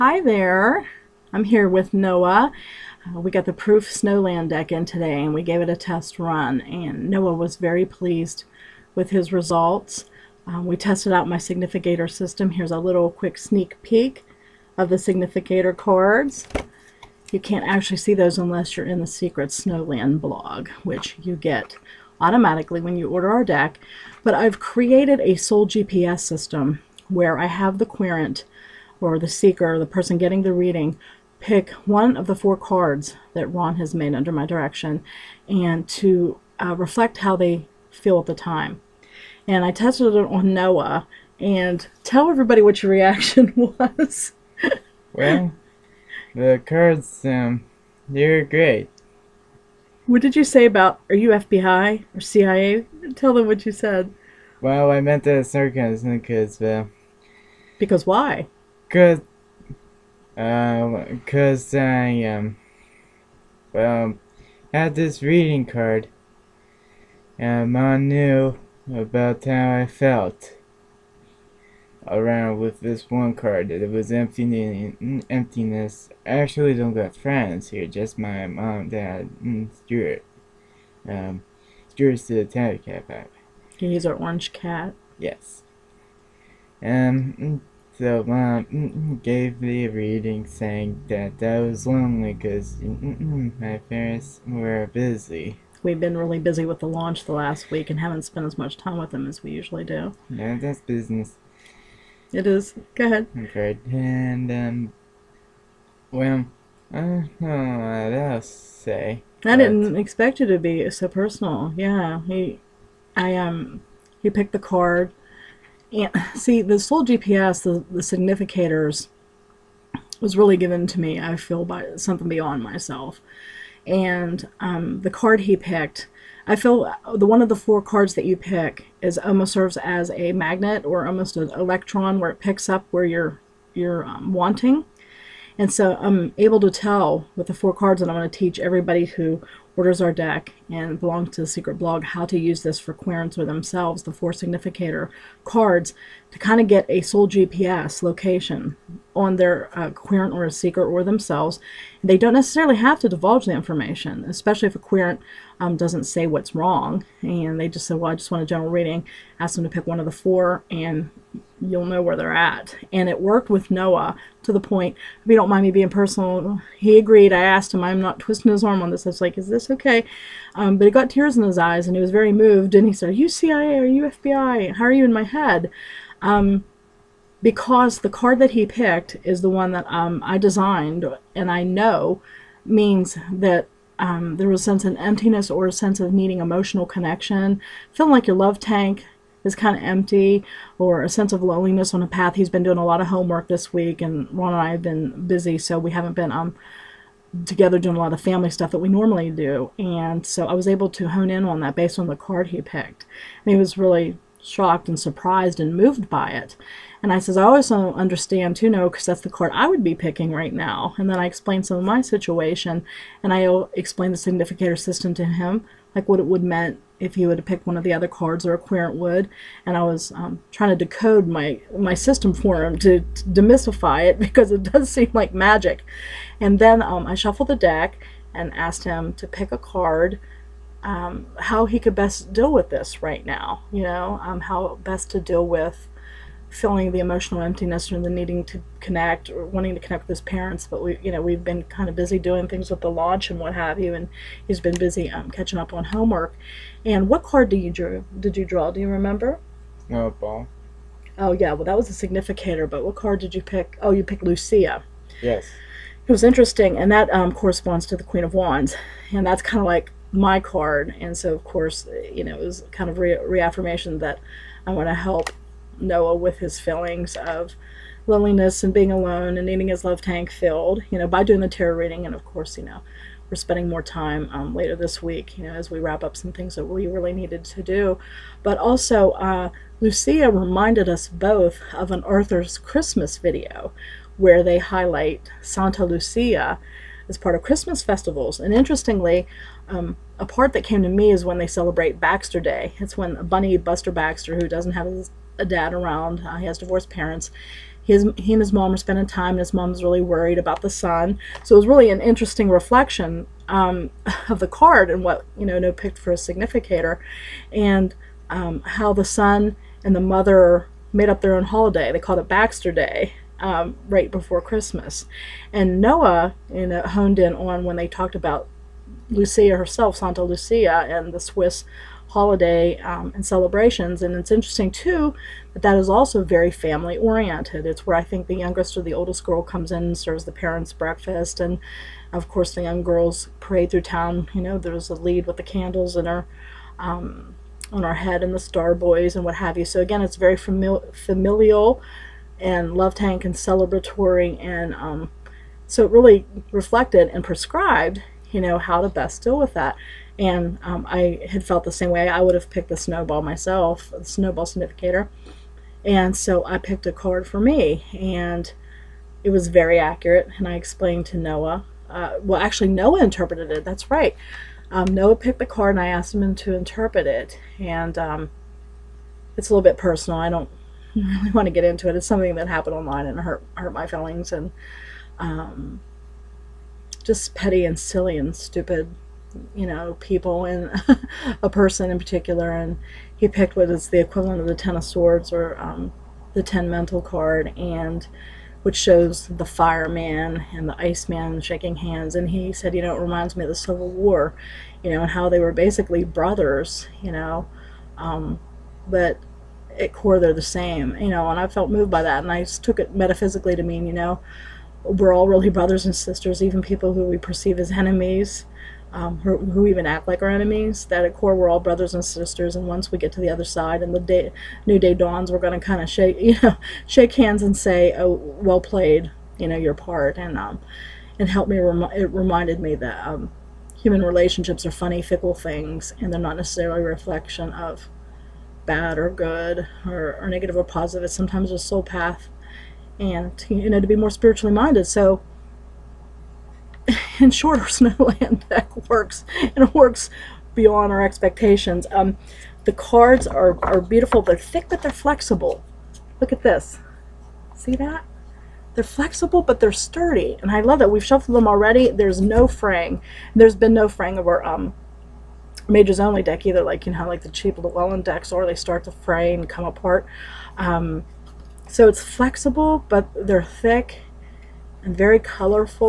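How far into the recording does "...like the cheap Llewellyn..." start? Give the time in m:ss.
7:37.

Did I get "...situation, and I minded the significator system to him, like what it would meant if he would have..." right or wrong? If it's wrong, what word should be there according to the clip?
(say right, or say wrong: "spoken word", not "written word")
wrong: "explained", not "minded".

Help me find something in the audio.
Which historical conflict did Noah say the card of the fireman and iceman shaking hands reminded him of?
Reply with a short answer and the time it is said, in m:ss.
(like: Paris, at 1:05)
Civil War, at 6:33.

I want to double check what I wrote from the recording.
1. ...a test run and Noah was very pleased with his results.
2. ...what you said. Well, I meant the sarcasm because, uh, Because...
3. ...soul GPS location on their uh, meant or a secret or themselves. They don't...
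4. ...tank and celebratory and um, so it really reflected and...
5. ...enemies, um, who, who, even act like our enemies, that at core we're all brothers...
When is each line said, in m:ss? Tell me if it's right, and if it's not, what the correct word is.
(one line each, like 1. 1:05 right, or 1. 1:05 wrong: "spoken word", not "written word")
1. 0:05 right
2. 0:53 right
3. 2:26 wrong: "querent", not "meant"
4. 5:42 right
5. 6:47 right.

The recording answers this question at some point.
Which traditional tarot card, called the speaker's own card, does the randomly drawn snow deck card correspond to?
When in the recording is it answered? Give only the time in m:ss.
4:18.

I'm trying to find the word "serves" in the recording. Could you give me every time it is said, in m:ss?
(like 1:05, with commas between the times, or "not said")
2:09, 5:29.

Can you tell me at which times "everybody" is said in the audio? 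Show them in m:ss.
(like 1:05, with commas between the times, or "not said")
0:42, 2:18.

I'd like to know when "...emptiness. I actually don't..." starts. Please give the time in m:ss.
1:15.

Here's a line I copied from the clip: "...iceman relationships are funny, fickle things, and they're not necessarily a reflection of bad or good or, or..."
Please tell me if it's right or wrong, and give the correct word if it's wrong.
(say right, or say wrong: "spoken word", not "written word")
wrong: "human", not "iceman".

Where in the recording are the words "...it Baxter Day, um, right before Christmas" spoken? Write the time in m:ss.
5:12.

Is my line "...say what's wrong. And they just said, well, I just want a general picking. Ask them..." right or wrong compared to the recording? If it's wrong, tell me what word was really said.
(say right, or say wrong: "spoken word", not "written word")
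wrong: "reading", not "picking".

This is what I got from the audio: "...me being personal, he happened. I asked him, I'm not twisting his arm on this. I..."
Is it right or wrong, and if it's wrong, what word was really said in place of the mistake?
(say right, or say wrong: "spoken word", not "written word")
wrong: "agreed", not "happened".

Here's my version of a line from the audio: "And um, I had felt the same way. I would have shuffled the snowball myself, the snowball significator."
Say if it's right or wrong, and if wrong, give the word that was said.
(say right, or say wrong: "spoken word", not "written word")
wrong: "picked", not "shuffled".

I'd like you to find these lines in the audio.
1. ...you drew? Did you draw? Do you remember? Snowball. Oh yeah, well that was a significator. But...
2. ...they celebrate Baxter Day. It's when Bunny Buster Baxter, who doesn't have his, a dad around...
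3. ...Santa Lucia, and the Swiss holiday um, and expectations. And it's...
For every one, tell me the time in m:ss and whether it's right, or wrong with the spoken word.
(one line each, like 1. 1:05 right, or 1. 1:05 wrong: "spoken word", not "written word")
1. 4:07 right
2. 4:51 right
3. 5:19 wrong: "celebrations", not "expectations".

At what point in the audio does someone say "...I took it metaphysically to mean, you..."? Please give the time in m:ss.
6:42.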